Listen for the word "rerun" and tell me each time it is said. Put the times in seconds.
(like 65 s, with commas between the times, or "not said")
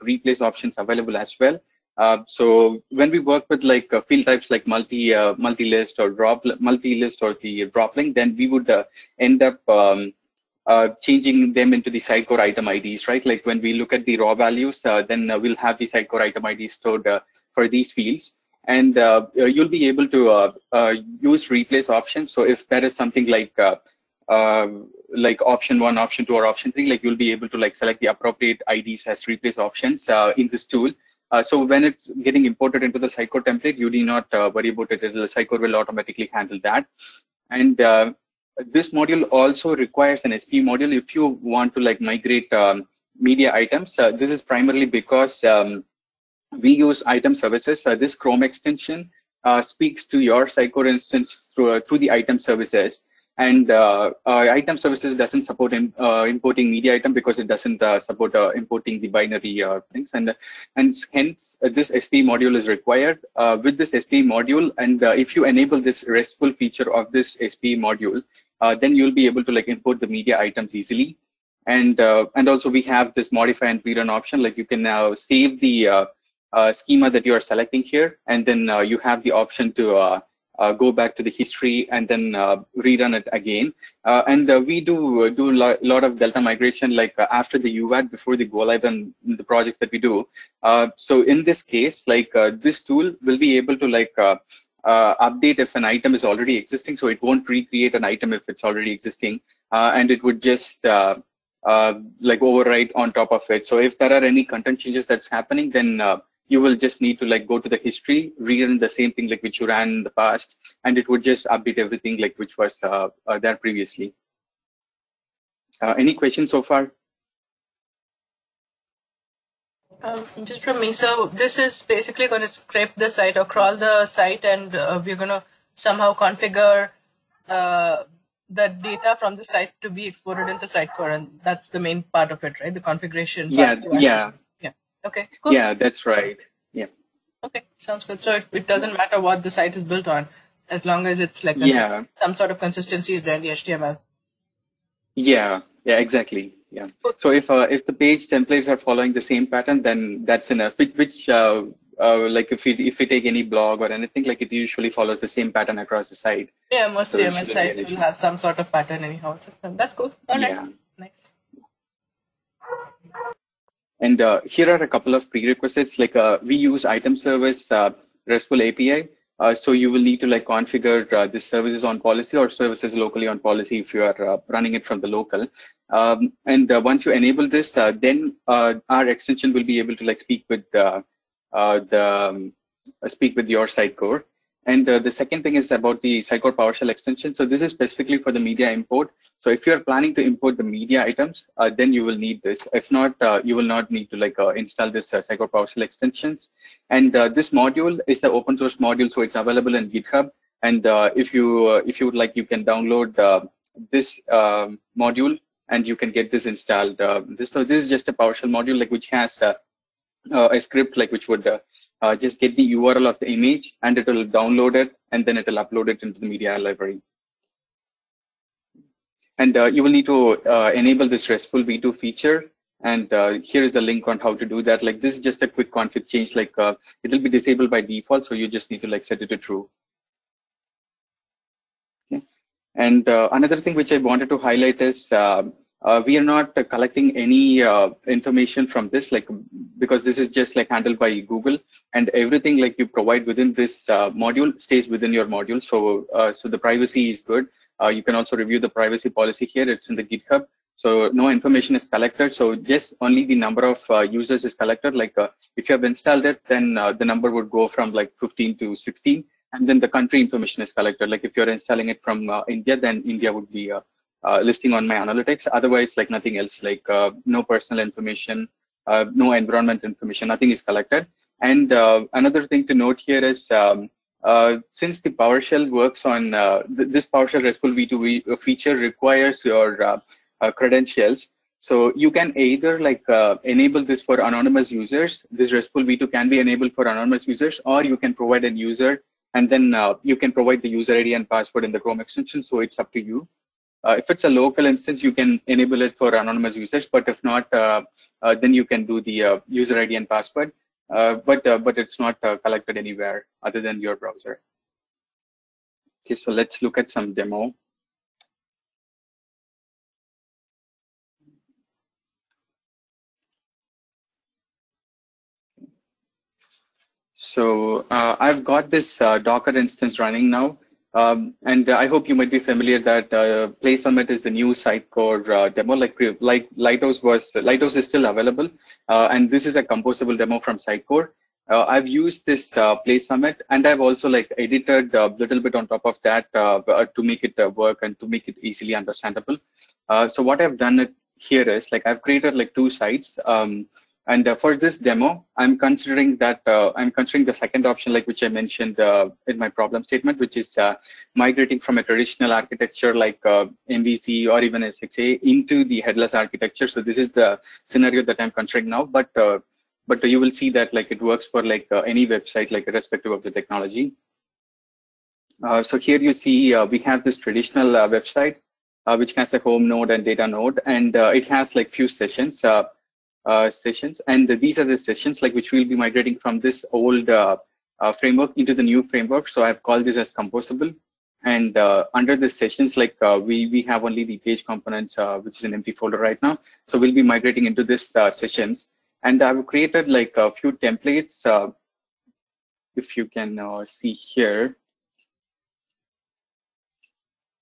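73 s, 82 s, 108 s.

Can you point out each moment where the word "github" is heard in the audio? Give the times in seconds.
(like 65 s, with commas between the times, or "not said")
199 s, 250 s.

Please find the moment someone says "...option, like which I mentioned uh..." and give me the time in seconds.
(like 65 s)
347 s.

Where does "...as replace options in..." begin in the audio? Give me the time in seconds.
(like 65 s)
29 s.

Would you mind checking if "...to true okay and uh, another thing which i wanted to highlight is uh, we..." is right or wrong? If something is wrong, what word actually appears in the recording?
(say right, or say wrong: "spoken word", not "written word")
right.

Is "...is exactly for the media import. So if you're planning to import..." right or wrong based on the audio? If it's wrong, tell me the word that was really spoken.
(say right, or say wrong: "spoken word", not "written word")
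wrong: "specifically", not "exactly".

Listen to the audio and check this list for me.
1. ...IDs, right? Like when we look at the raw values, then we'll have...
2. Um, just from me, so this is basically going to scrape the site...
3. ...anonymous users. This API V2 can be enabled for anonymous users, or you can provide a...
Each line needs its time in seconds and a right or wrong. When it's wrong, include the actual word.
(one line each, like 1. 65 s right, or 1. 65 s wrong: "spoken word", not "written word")
1. 12 s right
2. 120 s right
3. 284 s wrong: "RESTful", not "API".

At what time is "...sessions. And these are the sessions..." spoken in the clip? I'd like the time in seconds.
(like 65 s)
373 s.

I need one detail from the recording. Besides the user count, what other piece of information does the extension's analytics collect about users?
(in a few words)
Country.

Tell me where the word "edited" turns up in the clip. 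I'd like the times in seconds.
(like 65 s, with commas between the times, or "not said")
334 s.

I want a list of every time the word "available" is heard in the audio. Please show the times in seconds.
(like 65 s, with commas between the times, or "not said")
0 s, 199 s, 328 s.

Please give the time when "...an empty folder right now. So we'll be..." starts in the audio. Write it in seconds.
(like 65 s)
385 s.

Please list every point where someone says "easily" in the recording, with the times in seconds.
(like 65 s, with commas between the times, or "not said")
70 s, 338 s.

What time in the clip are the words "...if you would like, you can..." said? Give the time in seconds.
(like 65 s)
201 s.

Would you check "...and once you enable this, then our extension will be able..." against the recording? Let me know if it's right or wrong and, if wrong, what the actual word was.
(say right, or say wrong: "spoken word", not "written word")
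right.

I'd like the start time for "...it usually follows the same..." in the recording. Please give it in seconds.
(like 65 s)
154 s.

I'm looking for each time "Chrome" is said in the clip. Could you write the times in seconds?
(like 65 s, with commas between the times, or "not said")
48 s, 291 s.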